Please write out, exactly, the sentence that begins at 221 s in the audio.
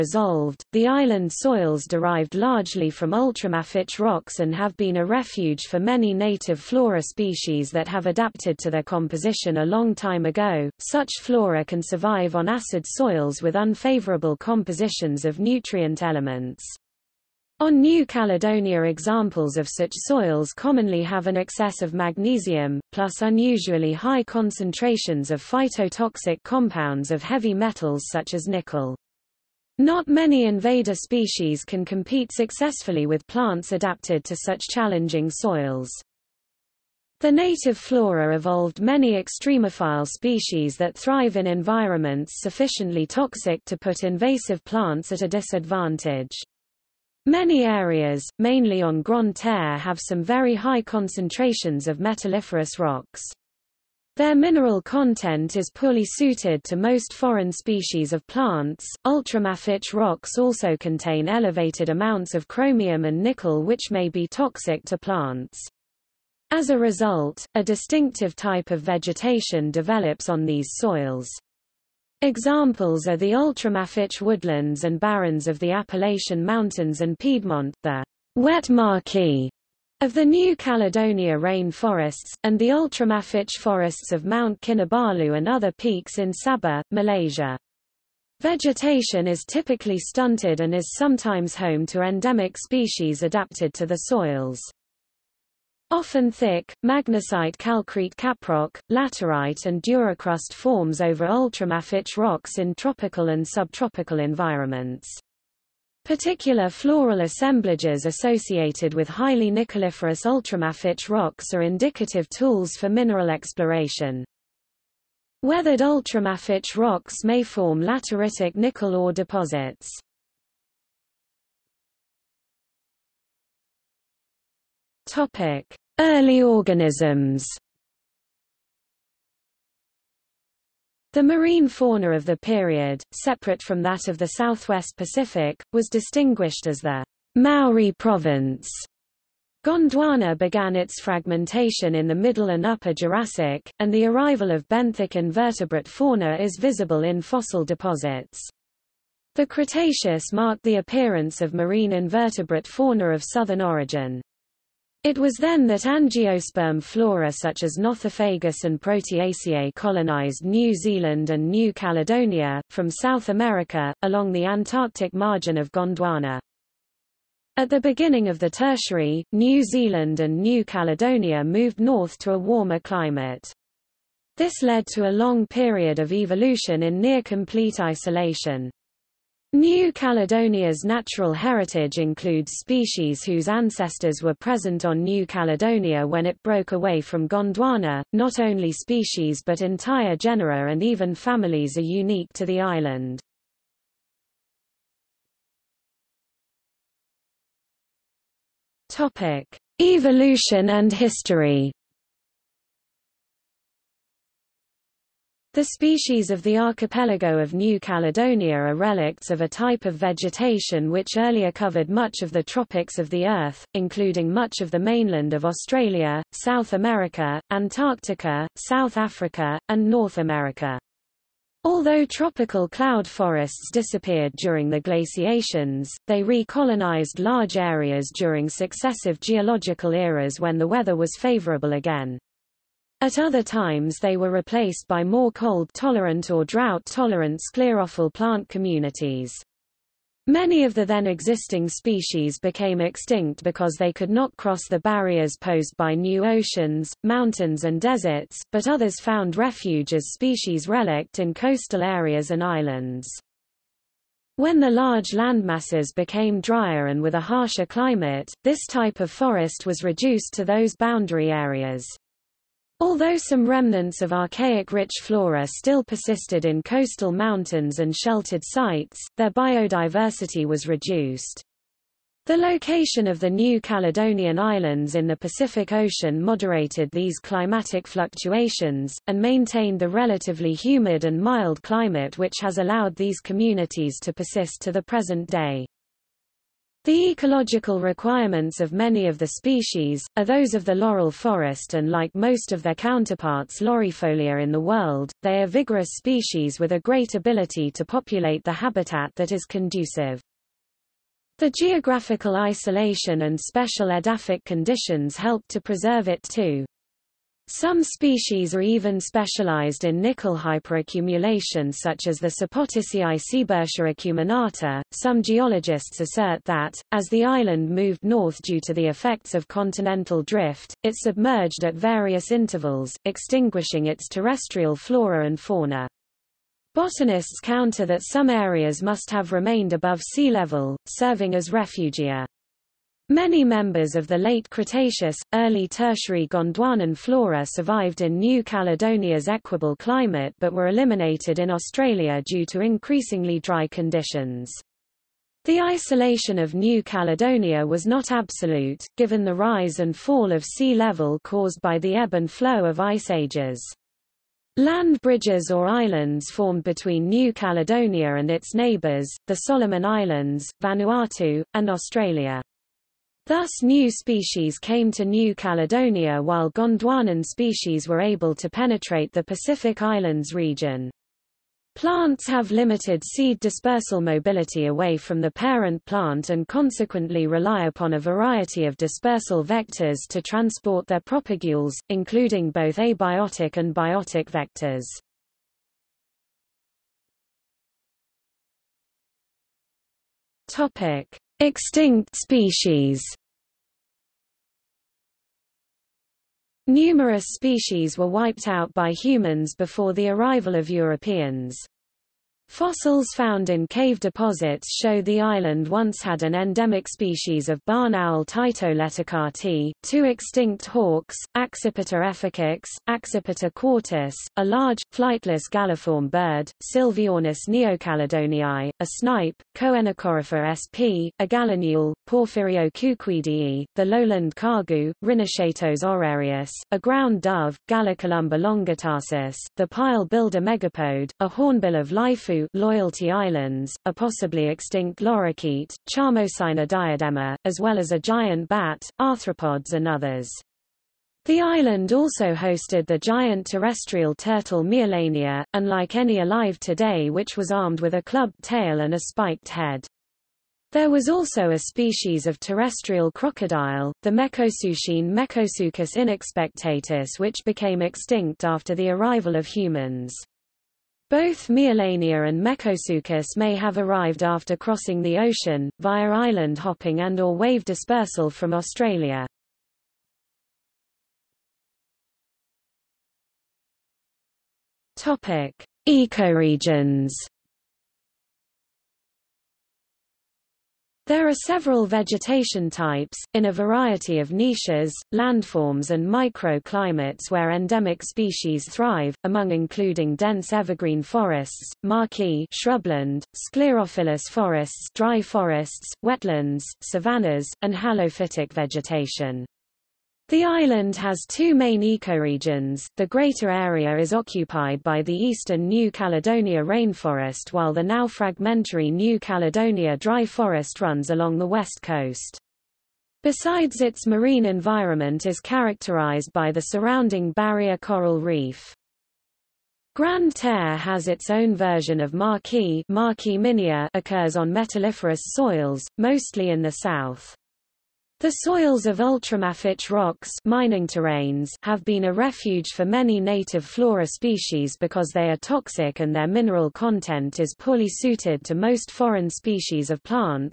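Although tropical cloud forests disappeared during the glaciations, they recolonized large areas during successive geological eras when the weather was favorable again.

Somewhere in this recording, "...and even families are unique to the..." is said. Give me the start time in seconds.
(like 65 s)
190 s.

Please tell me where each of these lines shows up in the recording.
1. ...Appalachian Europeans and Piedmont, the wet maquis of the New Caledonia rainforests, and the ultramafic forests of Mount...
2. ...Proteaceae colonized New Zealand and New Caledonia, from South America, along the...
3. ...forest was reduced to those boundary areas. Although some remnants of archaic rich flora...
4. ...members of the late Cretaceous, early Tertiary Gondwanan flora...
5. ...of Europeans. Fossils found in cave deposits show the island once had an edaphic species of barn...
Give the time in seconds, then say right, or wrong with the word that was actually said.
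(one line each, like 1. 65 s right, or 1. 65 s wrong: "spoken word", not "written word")
1. 75 s wrong: "Mountains", not "Europeans"
2. 158 s right
3. 259 s right
4. 333 s right
5. 400 s wrong: "endemic", not "edaphic".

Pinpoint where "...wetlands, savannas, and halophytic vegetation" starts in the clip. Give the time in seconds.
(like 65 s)
496 s.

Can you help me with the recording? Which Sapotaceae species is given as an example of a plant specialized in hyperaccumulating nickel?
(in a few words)
Sebertia acuminata.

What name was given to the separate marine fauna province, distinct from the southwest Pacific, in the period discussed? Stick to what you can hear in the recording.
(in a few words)
Maori province.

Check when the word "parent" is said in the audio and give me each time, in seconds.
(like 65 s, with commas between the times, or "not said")
375 s.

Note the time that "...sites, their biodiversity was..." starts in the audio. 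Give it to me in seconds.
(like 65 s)
268 s.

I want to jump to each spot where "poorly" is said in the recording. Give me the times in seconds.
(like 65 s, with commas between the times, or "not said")
55 s, 537 s.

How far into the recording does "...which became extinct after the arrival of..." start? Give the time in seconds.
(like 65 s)
457 s.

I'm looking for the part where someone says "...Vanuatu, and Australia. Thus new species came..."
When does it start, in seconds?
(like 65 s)
360 s.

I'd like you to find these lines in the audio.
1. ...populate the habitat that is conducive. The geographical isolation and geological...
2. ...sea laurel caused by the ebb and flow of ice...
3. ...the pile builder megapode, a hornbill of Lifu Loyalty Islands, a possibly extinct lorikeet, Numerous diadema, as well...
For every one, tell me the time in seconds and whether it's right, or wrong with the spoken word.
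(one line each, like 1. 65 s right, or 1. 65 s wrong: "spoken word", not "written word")
1. 297 s wrong: "special", not "geological"
2. 350 s wrong: "level", not "laurel"
3. 429 s wrong: "Charmosina", not "Numerous".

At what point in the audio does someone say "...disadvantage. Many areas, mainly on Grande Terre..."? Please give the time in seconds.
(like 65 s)
45 s.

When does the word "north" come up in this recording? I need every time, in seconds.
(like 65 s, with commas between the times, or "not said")
171 s, 219 s, 318 s.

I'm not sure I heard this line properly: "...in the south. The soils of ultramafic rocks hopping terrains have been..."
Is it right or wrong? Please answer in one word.
wrong.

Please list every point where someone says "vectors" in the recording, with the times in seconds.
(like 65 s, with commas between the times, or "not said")
379 s, 384 s.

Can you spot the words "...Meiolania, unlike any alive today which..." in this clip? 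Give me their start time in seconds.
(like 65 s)
444 s.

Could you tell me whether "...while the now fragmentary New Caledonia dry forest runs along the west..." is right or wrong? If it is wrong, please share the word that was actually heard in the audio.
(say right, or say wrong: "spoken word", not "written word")
right.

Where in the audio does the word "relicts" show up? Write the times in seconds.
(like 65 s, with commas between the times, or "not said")
208 s, 250 s.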